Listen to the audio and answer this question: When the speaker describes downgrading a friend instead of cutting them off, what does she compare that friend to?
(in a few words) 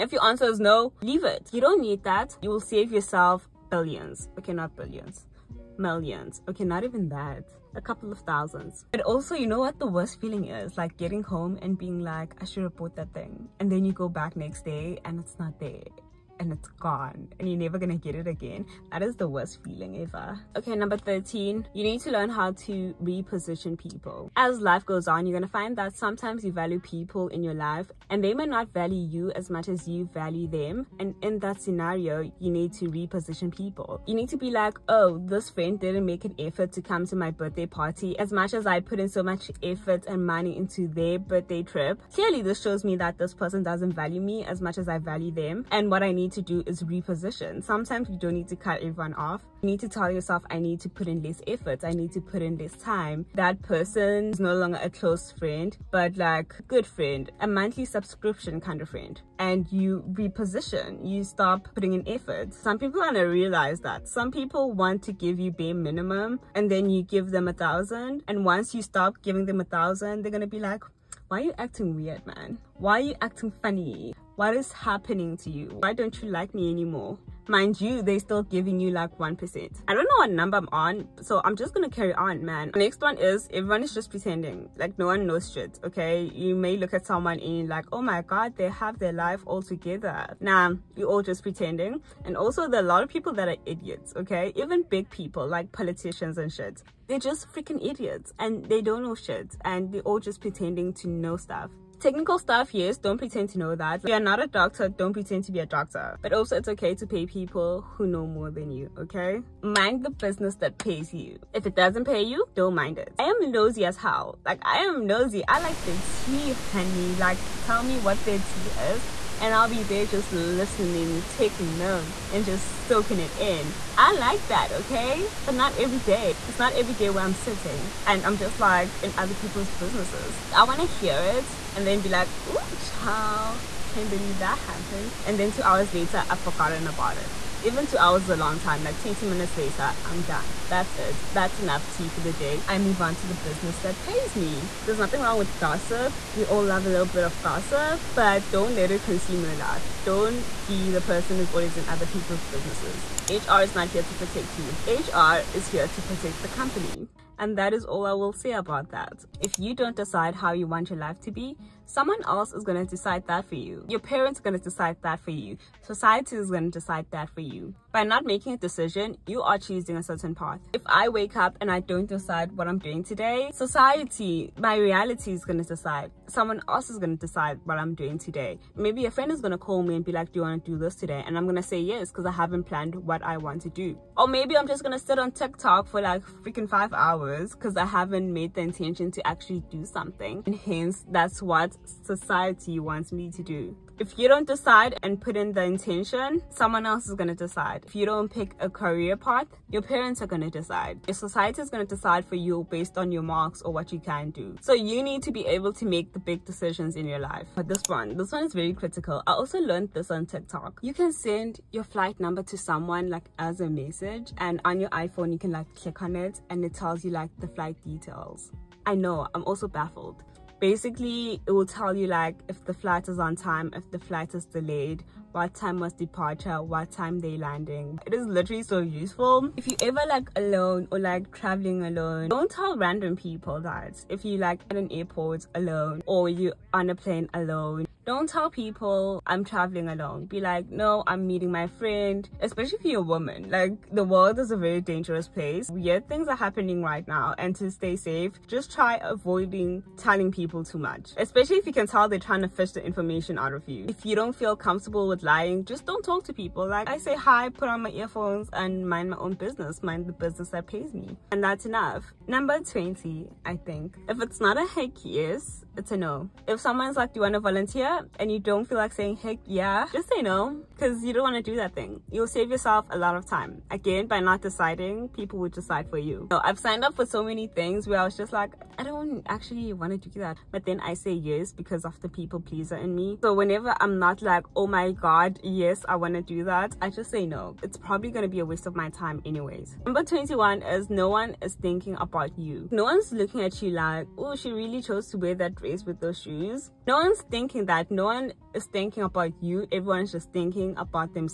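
monthly subscription.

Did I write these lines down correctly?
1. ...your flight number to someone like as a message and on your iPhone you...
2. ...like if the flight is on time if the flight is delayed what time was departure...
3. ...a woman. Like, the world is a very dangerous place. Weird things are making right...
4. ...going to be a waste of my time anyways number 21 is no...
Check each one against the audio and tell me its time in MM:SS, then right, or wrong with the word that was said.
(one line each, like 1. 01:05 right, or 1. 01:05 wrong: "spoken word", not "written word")
1. 03:31 right
2. 03:42 right
3. 04:02 wrong: "happening", not "making"
4. 04:48 right.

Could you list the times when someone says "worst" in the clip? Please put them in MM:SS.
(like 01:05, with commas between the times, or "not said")
00:09, 00:19.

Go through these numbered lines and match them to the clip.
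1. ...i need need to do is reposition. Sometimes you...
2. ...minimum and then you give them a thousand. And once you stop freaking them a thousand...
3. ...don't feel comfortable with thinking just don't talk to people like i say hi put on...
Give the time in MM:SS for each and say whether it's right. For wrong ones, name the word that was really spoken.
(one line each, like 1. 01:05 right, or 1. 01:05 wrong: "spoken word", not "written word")
1. 00:46 right
2. 01:05 wrong: "giving", not "freaking"
3. 04:14 wrong: "lying", not "thinking".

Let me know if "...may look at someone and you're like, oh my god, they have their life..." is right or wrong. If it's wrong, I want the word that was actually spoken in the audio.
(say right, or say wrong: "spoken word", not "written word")
right.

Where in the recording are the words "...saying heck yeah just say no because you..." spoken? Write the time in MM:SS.
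04:28.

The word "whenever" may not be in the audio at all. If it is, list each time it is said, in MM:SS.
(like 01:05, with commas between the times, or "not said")
04:43.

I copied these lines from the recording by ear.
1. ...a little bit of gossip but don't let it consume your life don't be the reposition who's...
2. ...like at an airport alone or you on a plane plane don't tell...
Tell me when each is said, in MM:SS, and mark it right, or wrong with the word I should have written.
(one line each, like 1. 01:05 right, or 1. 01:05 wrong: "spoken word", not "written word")
1. 02:26 wrong: "person", not "reposition"
2. 03:54 wrong: "alone", not "plane".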